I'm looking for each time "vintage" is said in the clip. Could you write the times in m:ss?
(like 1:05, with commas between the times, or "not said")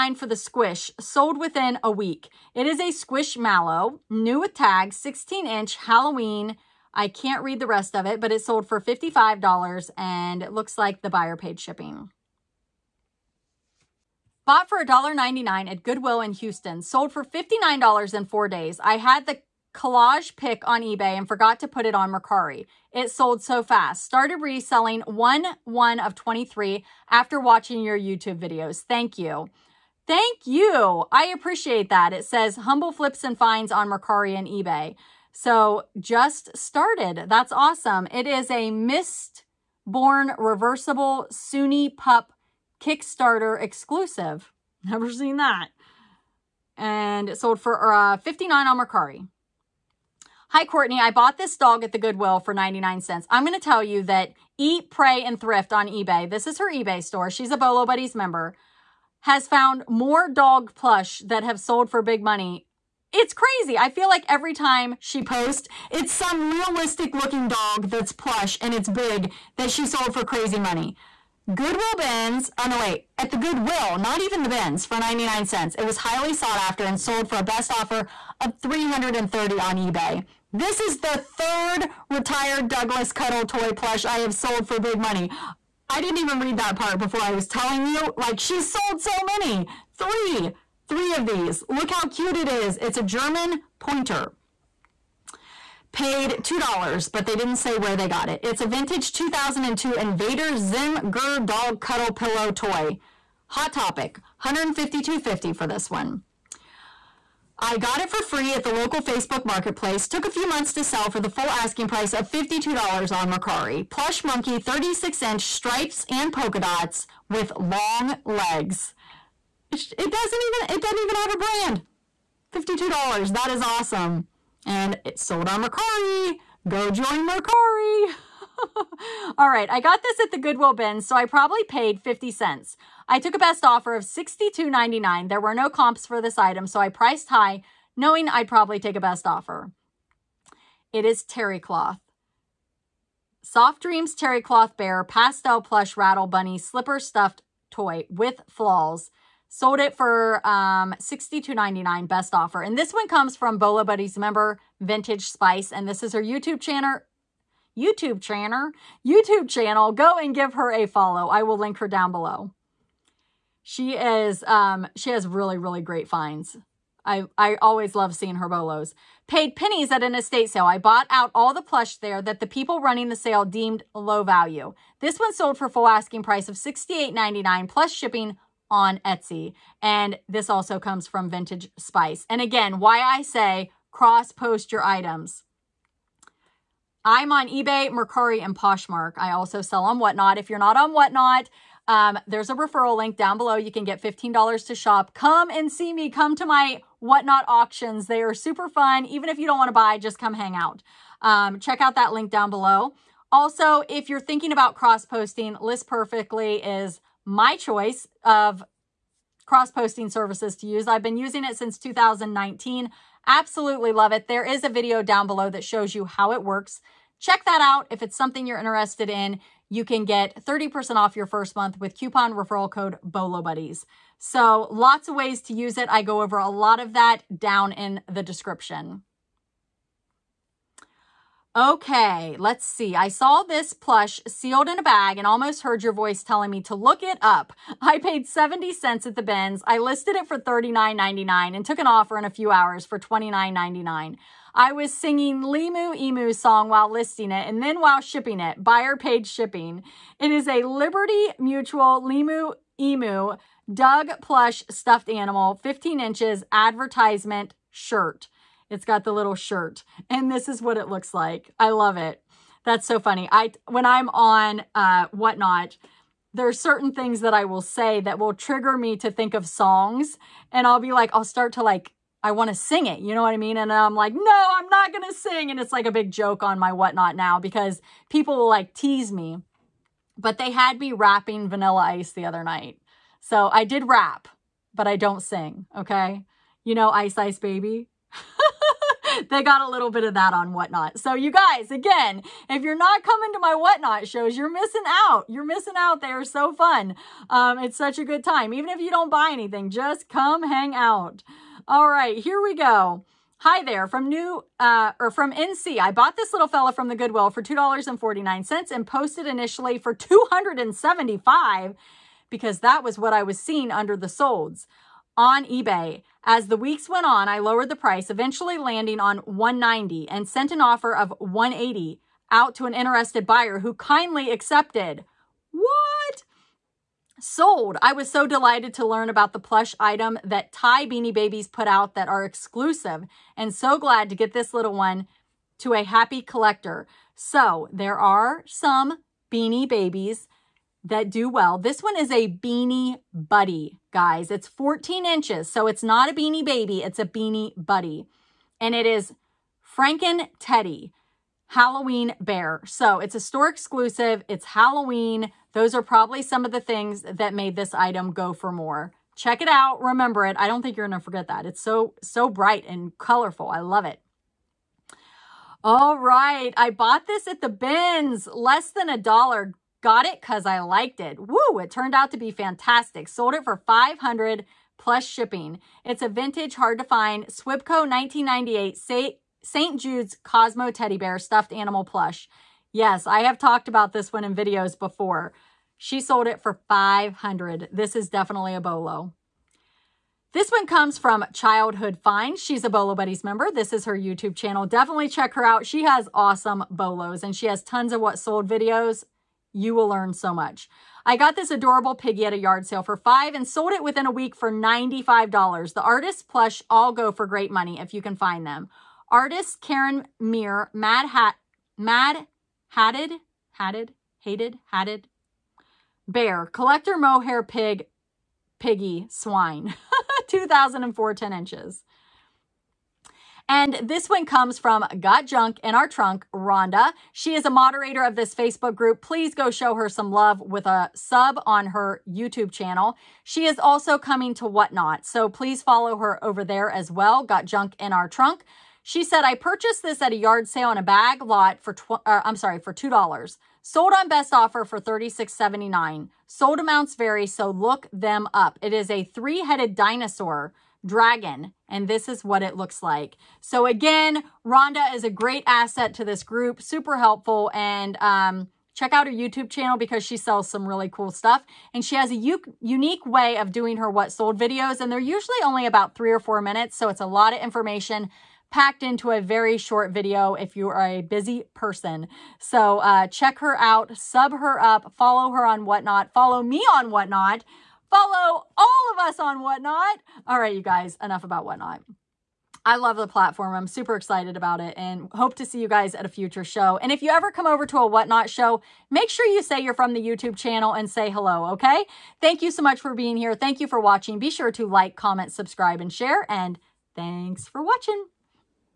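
1:38, 2:34, 3:01, 6:16.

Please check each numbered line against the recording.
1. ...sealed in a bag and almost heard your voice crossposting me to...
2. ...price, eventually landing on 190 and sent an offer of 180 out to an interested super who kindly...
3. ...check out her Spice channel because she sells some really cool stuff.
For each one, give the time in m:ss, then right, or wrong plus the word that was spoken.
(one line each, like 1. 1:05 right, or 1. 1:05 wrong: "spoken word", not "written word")
1. 3:54 wrong: "telling", not "crossposting"
2. 5:17 wrong: "buyer", not "super"
3. 7:38 wrong: "YouTube", not "Spice".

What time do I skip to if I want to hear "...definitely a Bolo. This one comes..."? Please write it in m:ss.
6:28.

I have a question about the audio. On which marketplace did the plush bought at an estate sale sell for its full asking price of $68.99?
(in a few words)
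Etsy.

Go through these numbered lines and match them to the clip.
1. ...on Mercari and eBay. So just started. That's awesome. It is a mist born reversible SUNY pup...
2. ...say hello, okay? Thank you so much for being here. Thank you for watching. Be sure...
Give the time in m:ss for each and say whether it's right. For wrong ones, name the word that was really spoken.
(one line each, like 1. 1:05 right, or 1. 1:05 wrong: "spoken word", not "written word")
1. 0:33 right
2. 8:10 right.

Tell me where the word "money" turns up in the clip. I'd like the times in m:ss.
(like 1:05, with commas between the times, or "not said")
1:02, 1:10, 1:24, 6:47.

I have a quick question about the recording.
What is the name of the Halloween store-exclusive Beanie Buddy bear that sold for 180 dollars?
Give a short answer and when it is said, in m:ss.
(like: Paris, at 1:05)
Franken Teddy, at 5:49.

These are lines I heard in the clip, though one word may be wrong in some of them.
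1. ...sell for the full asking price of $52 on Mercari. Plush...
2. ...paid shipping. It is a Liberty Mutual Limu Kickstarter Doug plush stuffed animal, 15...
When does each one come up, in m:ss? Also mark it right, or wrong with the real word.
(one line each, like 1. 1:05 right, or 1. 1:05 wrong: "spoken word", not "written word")
1. 1:50 right
2. 4:08 wrong: "Emu", not "Kickstarter".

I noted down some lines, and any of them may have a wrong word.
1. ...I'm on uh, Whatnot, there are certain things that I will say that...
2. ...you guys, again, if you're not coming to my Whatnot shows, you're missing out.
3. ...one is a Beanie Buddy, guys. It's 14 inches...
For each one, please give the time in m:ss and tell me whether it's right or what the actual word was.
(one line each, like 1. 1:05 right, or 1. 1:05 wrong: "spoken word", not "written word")
1. 4:23 right
2. 4:51 right
3. 5:41 right.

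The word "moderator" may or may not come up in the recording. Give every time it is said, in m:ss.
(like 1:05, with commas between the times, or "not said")
7:07.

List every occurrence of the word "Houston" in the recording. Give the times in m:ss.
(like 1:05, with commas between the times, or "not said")
0:16.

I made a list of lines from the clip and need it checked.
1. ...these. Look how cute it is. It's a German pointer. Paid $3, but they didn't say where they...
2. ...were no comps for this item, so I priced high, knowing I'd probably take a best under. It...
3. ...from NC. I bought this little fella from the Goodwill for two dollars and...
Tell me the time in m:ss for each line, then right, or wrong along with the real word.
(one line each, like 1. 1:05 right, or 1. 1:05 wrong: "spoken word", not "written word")
1. 1:31 wrong: "2", not "3"
2. 2:15 wrong: "offer", not "under"
3. 5:05 right.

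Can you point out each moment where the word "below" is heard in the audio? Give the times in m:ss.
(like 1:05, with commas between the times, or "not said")
2:42, 3:13, 3:22, 3:35.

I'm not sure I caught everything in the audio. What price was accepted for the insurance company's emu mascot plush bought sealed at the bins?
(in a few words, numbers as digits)
$29.99.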